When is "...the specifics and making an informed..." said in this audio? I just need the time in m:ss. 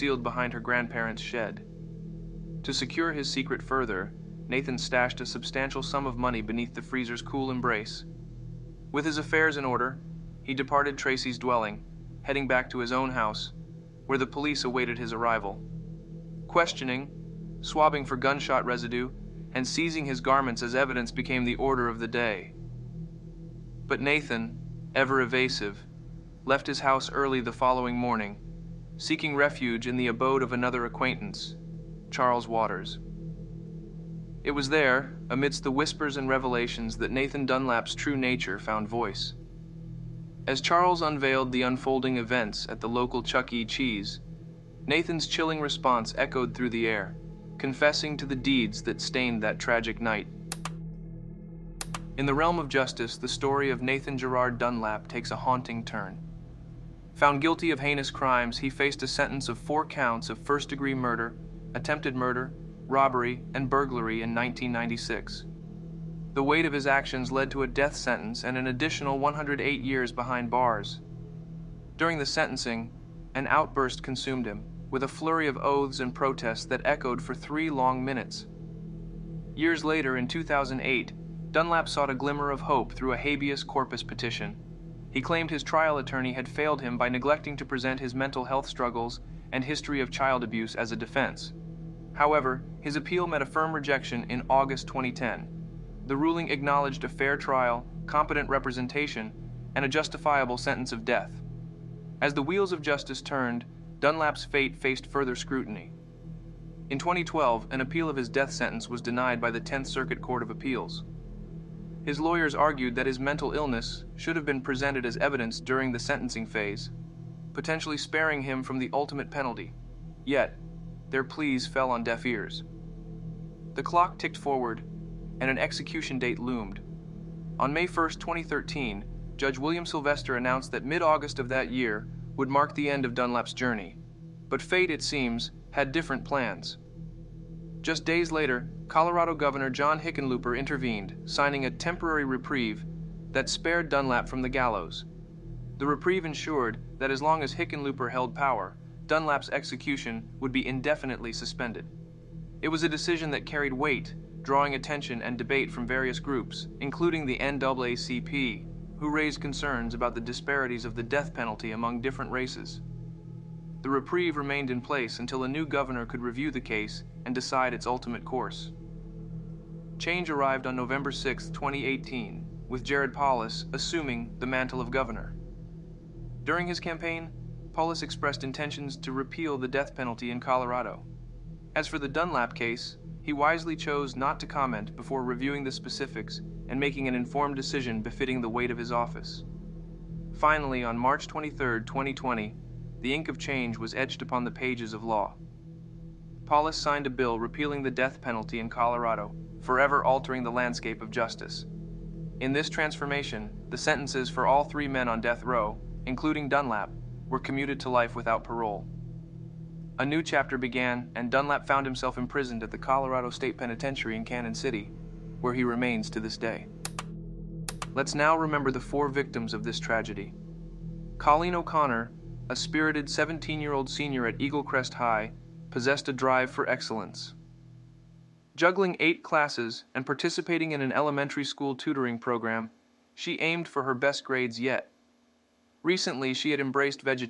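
3:05.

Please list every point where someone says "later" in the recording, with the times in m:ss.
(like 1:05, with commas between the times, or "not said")
1:19, 2:18.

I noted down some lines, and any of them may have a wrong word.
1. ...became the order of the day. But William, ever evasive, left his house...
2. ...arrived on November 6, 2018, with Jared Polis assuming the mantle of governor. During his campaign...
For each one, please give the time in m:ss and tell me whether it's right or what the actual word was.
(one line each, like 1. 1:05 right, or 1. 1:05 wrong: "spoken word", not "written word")
1. 0:21 wrong: "Nathan", not "William"
2. 2:50 right.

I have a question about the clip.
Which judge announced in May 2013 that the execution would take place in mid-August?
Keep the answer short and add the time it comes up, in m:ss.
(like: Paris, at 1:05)
William Sylvester, at 2:09.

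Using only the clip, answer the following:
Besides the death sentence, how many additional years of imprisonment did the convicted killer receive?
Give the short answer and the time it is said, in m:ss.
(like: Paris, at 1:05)
108, at 1:09.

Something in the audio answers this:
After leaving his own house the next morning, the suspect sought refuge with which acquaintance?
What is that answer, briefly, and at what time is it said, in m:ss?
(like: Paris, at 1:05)
Charles Waters, at 0:32.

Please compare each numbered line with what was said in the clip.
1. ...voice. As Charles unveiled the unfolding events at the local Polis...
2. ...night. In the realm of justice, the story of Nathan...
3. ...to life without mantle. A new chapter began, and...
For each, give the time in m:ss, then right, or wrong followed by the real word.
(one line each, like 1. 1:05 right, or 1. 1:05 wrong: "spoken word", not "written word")
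1. 0:38 wrong: "Chuck", not "Polis"
2. 0:50 right
3. 3:27 wrong: "parole", not "mantle".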